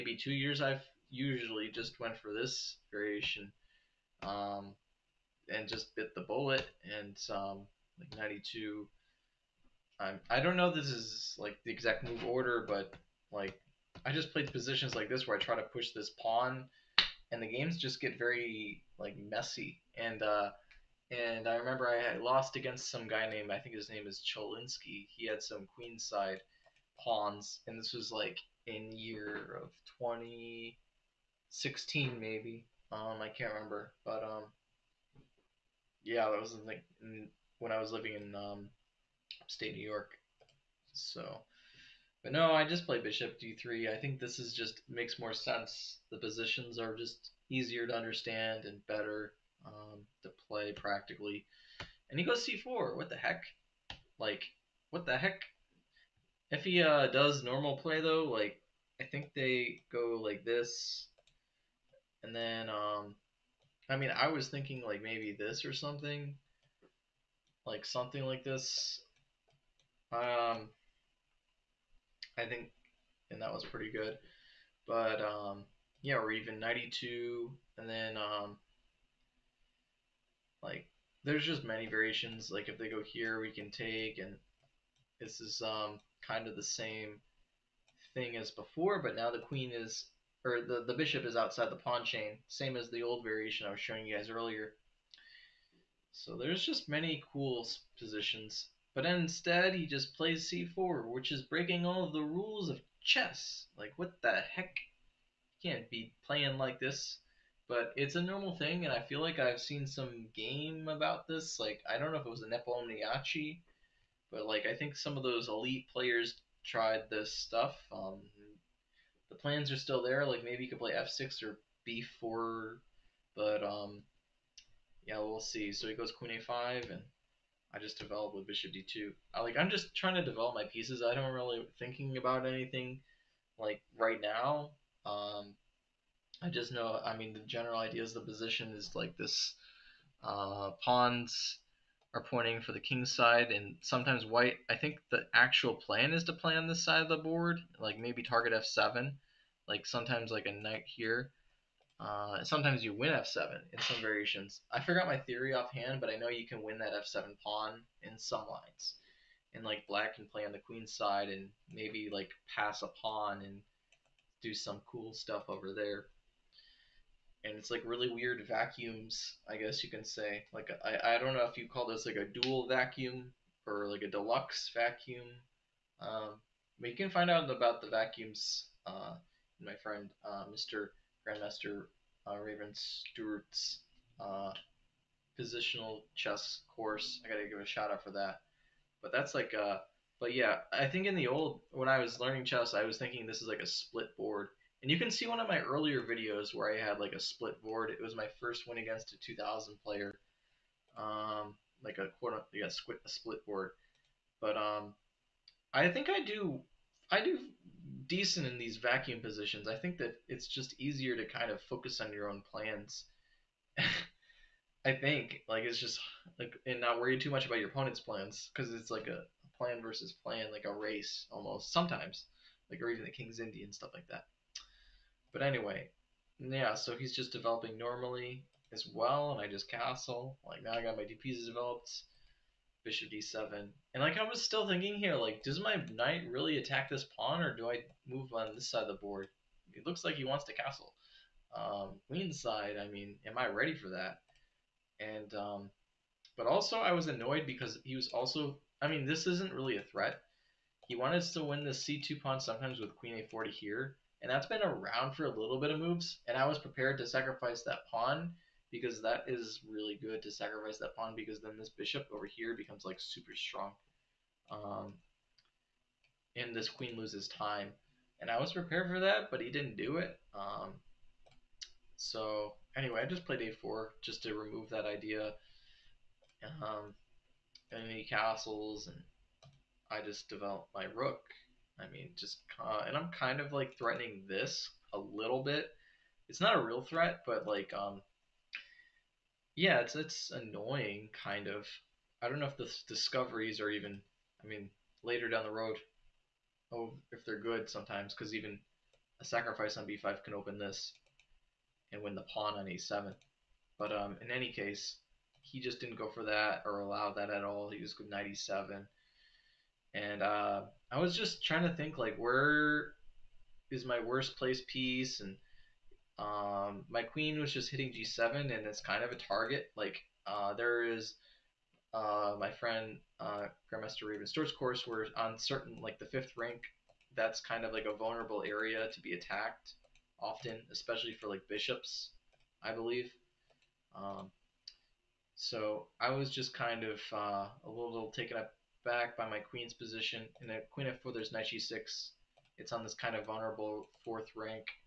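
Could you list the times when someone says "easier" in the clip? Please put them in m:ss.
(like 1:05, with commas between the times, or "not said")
0:47, 3:30.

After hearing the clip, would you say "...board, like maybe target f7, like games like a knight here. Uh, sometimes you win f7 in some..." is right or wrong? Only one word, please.
wrong.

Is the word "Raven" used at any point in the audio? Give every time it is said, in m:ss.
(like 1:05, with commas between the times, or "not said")
3:02, 5:24.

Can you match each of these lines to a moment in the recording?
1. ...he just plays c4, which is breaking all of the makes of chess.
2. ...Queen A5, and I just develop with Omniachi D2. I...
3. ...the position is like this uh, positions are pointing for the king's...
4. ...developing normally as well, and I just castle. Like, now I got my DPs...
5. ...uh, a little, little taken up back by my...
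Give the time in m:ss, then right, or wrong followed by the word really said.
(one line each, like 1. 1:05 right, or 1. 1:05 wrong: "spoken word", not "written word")
1. 1:39 wrong: "rules", not "makes"
2. 2:06 wrong: "Bishop", not "Omniachi"
3. 2:18 wrong: "pawns", not "positions"
4. 3:47 right
5. 5:37 right.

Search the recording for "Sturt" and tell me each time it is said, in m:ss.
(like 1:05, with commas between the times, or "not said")
3:02, 5:24.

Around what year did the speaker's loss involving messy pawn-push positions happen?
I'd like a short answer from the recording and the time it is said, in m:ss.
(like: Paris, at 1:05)
2016, at 0:29.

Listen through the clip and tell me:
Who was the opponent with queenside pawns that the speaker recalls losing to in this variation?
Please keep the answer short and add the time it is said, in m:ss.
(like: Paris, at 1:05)
Cholinsky, at 0:24.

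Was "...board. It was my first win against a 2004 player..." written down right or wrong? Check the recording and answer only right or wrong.
wrong.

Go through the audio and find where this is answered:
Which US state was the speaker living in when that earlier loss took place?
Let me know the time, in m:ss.
0:39.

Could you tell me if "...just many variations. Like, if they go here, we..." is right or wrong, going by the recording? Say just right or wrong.
right.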